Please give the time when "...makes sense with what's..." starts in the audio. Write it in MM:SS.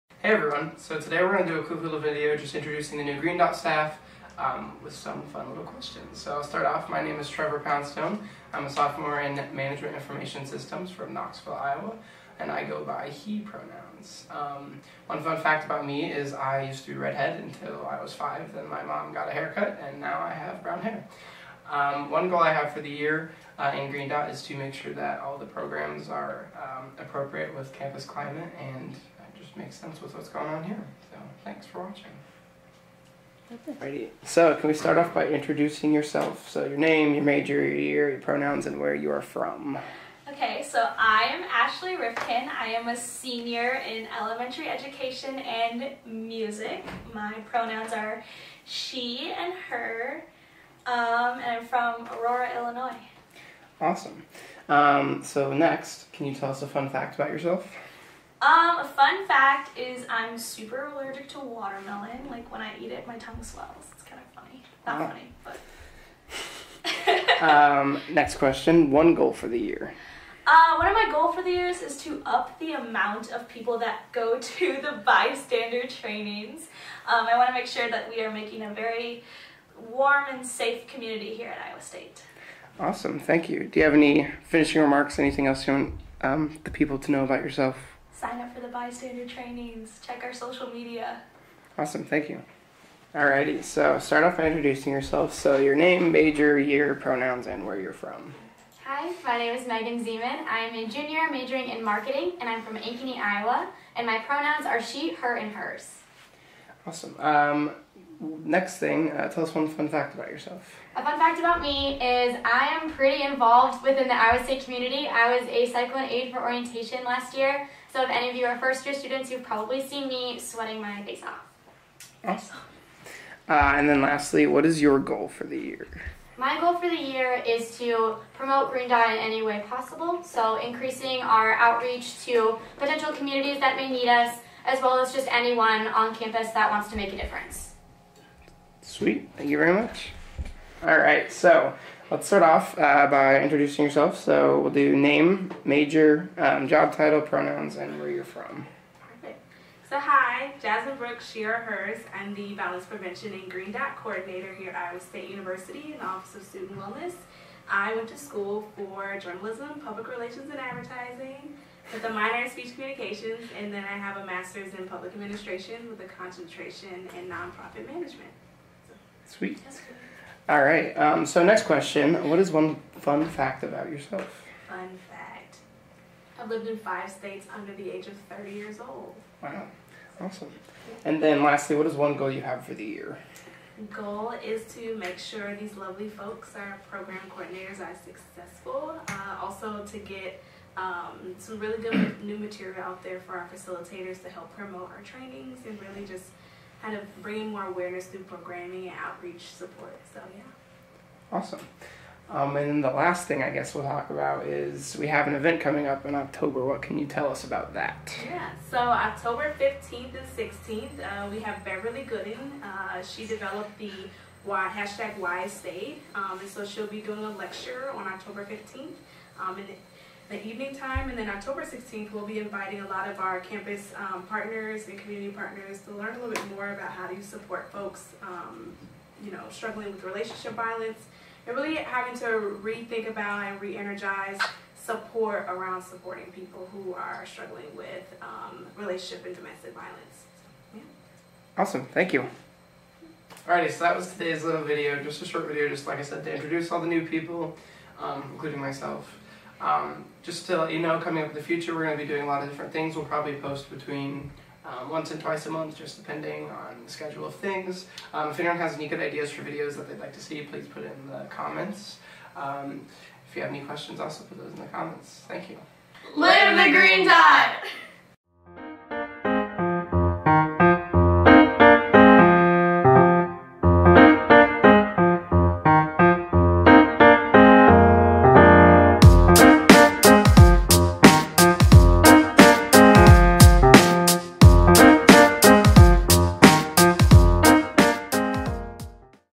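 00:29.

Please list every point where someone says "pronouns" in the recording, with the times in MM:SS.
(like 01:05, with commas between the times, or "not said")
00:13, 00:38, 00:47, 01:36, 01:44, 02:27.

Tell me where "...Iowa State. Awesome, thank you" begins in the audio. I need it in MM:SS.
01:21.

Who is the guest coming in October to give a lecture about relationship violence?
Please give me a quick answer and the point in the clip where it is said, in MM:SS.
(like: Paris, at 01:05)
Beverly Gooden, at 03:31.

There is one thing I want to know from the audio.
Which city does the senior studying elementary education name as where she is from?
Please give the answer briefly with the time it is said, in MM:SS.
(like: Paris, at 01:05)
Aurora, Illinois, at 00:52.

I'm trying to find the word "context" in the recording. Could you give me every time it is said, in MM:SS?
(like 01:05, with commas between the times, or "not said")
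not said.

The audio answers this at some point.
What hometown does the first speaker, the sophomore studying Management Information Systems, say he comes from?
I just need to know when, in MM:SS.
00:11.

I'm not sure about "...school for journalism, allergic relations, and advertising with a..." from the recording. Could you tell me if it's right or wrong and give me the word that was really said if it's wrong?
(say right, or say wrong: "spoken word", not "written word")
wrong: "public", not "allergic".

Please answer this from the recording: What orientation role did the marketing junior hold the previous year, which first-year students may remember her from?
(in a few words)
cyclone aide.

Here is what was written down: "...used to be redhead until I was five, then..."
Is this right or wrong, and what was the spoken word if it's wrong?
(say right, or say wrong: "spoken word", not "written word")
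right.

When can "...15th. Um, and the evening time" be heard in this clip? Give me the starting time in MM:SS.
03:38.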